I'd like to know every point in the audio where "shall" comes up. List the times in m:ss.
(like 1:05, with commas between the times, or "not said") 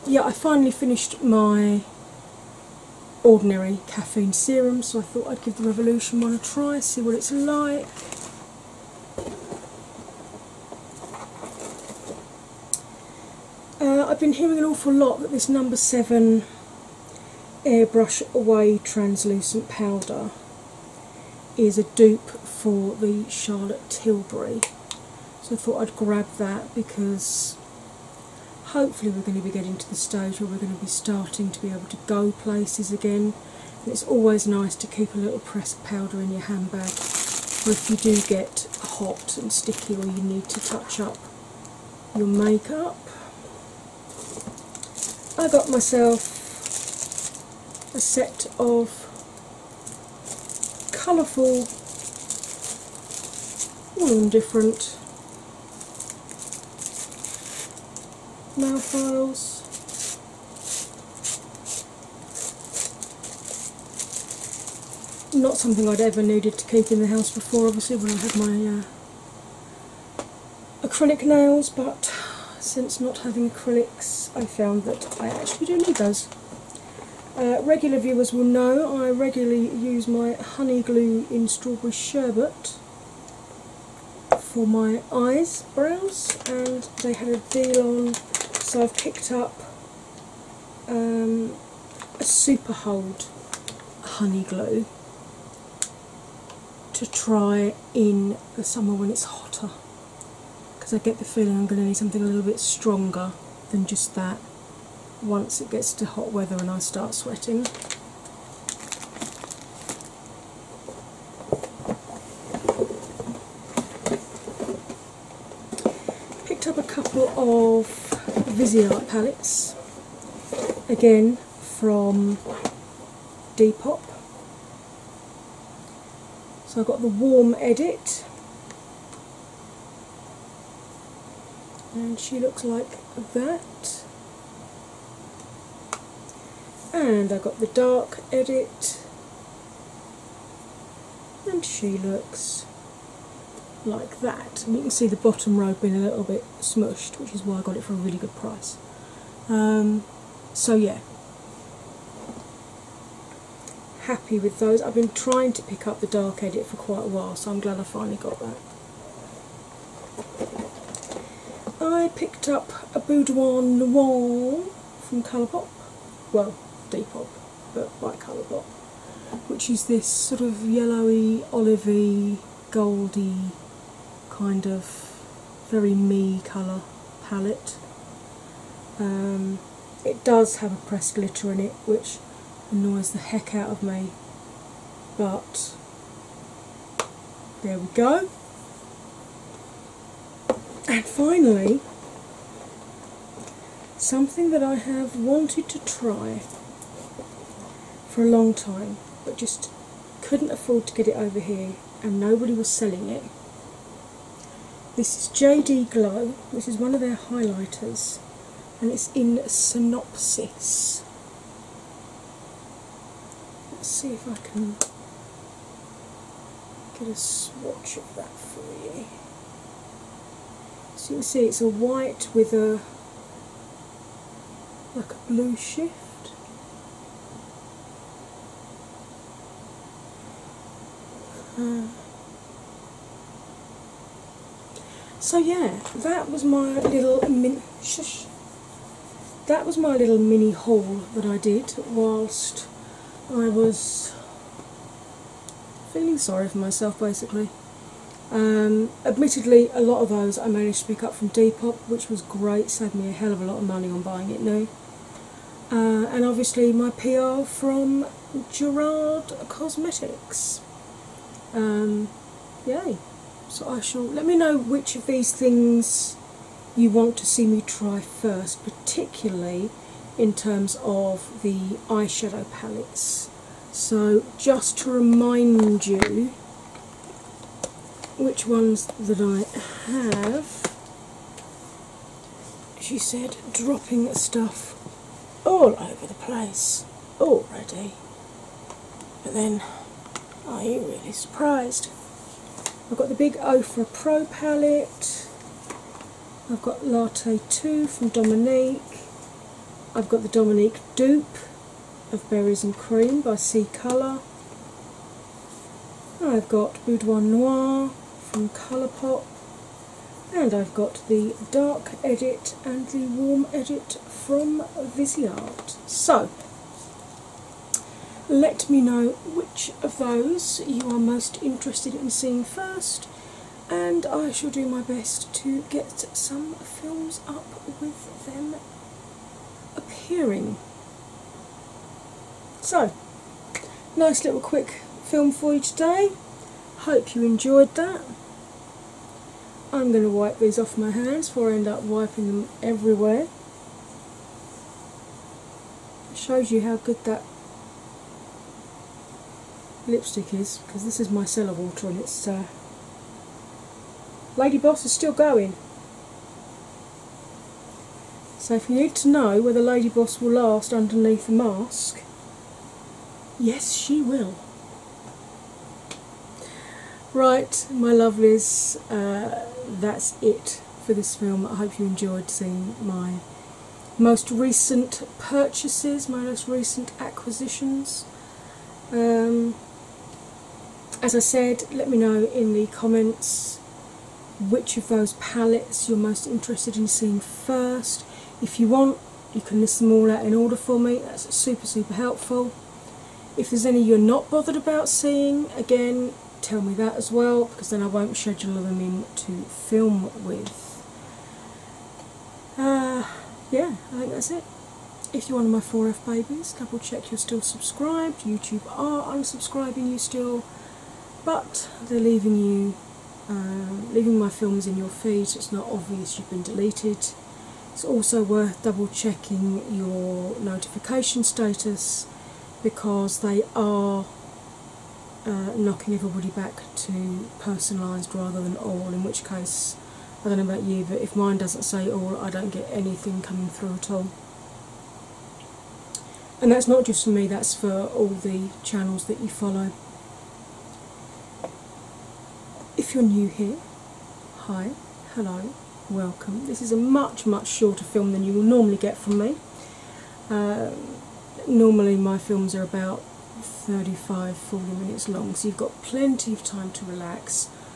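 4:23, 5:24.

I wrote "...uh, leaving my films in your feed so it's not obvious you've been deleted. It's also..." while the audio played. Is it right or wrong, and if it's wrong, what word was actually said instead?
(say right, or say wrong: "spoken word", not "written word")
right.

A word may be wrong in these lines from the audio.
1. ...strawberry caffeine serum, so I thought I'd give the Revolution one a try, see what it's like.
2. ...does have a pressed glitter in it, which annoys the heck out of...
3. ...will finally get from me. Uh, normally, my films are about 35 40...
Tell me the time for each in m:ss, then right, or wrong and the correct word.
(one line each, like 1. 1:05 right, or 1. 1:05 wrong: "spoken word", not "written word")
1. 0:03 wrong: "ordinary", not "strawberry"
2. 3:00 right
3. 7:28 wrong: "normally", not "finally".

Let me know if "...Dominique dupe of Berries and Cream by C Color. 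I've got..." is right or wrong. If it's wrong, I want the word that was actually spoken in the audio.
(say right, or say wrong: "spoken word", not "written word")
right.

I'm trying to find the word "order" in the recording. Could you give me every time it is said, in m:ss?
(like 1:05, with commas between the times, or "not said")
6:30.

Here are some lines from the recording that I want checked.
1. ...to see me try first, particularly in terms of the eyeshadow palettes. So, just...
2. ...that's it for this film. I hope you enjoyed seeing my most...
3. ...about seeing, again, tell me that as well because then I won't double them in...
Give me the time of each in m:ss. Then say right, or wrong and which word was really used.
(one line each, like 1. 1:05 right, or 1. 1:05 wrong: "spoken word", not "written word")
1. 4:27 right
2. 6:09 right
3. 6:34 wrong: "schedule", not "double".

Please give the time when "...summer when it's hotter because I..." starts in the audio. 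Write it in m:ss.
1:38.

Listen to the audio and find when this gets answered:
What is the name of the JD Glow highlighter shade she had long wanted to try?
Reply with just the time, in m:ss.
3:29.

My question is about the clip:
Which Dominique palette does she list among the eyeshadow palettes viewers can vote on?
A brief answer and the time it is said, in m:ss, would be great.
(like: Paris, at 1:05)
Latte 2, at 4:56.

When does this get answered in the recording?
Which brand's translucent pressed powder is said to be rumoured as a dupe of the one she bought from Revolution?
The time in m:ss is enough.
0:23.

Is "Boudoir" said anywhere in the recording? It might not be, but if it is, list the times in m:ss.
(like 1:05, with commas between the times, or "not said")
2:43, 5:06.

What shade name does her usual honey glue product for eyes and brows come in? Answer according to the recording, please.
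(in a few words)
strawberry sherbet.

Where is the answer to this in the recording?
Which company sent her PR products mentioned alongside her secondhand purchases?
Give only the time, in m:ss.
4:18.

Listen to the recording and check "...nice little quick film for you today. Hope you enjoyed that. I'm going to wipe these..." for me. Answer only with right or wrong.
right.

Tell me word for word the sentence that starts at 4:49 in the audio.
But then, are you really surprised?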